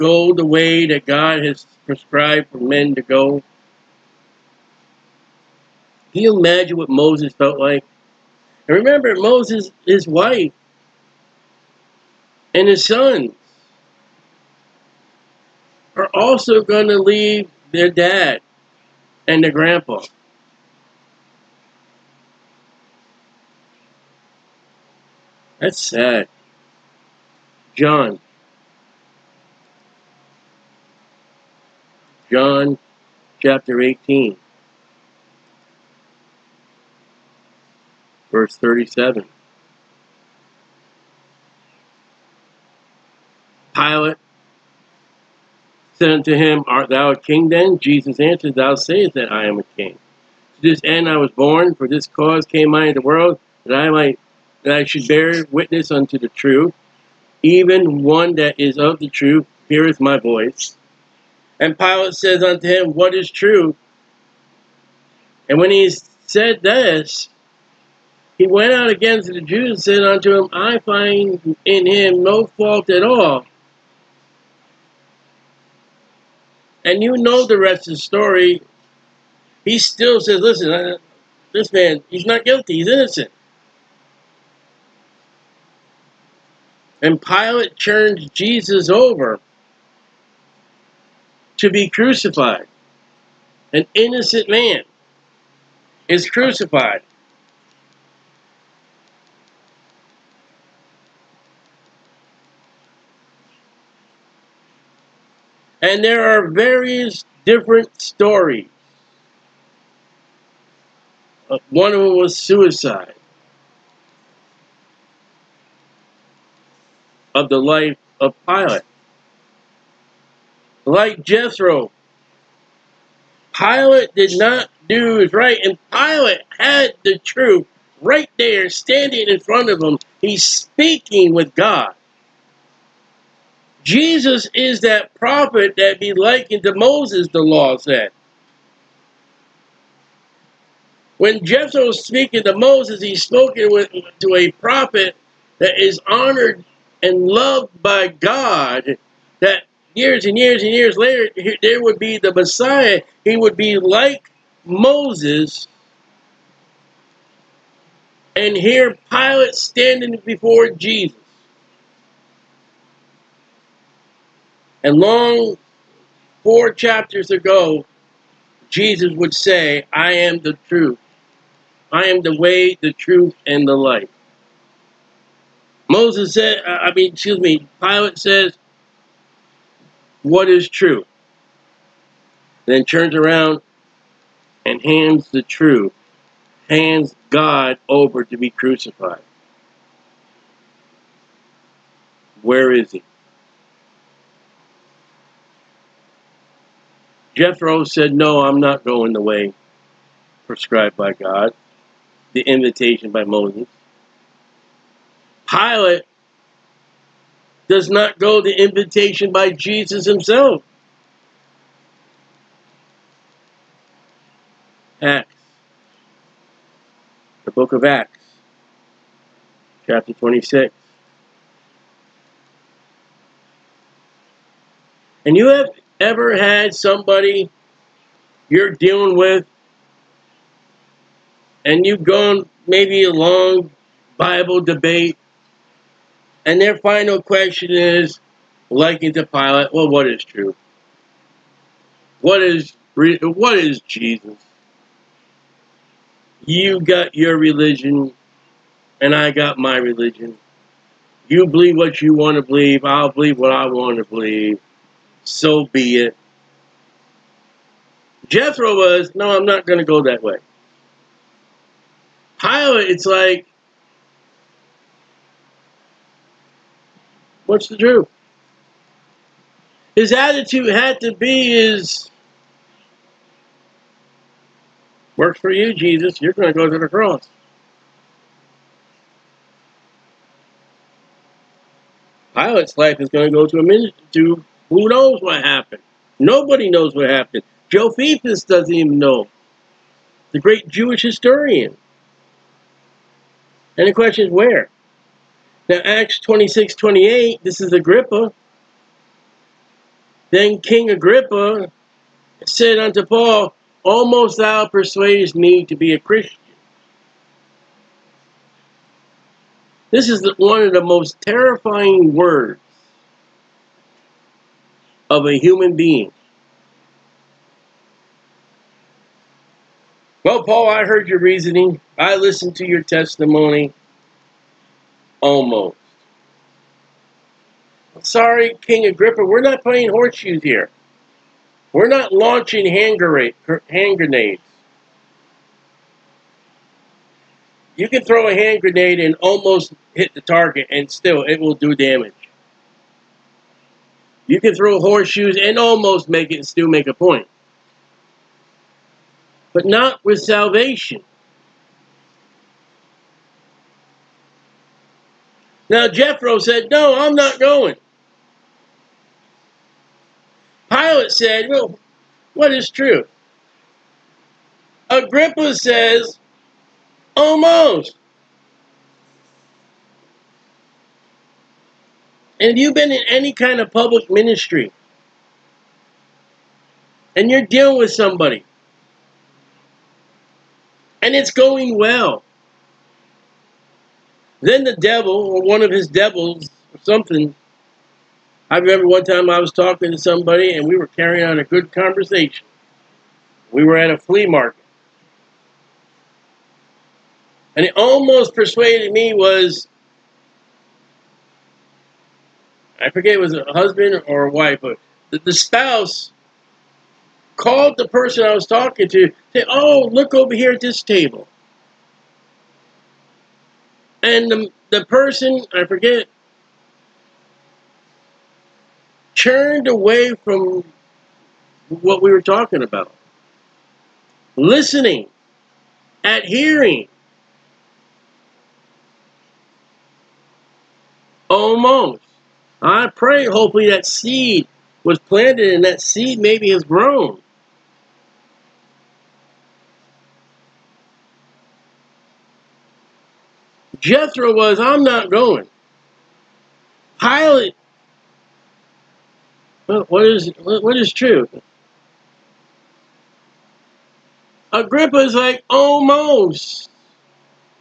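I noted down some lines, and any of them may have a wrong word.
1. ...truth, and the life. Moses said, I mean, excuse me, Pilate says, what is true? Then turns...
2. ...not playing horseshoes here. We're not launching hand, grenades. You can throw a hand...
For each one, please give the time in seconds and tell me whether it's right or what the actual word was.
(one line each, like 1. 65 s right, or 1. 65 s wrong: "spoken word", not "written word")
1. 172 s right
2. 329 s right.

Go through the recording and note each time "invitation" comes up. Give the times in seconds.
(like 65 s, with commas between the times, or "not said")
202 s, 208 s.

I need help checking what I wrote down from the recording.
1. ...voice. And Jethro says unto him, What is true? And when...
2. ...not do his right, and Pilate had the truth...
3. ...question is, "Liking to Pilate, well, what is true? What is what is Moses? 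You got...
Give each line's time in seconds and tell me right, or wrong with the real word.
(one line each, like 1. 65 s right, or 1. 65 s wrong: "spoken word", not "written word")
1. 60 s wrong: "Pilate", not "Jethro"
2. 124 s right
3. 237 s wrong: "Jesus", not "Moses".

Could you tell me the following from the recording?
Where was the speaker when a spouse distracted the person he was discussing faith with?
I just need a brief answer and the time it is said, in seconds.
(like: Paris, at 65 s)
A flea market, at 393 s.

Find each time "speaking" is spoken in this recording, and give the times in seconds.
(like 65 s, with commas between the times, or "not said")
130 s, 142 s.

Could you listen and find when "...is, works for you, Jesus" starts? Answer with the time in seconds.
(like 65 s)
271 s.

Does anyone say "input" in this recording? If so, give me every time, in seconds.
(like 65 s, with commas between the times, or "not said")
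not said.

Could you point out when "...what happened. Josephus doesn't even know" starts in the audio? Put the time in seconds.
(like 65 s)
286 s.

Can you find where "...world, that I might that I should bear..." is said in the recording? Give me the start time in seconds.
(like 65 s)
53 s.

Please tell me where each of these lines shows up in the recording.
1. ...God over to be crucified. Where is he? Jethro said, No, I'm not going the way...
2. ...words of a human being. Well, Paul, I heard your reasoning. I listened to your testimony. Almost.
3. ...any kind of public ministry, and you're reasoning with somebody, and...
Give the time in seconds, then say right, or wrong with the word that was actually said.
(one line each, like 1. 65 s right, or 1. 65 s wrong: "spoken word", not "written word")
1. 187 s right
2. 312 s right
3. 373 s wrong: "dealing", not "reasoning".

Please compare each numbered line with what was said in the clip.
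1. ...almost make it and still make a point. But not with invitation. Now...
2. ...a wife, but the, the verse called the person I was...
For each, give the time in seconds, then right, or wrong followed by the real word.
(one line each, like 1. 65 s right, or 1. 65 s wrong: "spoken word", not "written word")
1. 345 s wrong: "salvation", not "invitation"
2. 404 s wrong: "spouse", not "verse".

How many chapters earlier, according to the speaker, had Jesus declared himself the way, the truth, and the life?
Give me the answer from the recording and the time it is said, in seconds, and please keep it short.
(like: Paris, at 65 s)
4, at 166 s.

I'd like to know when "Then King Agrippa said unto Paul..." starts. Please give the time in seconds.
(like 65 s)
300 s.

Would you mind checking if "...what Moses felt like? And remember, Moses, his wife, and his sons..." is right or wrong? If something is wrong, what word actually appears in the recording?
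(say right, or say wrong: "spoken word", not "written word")
right.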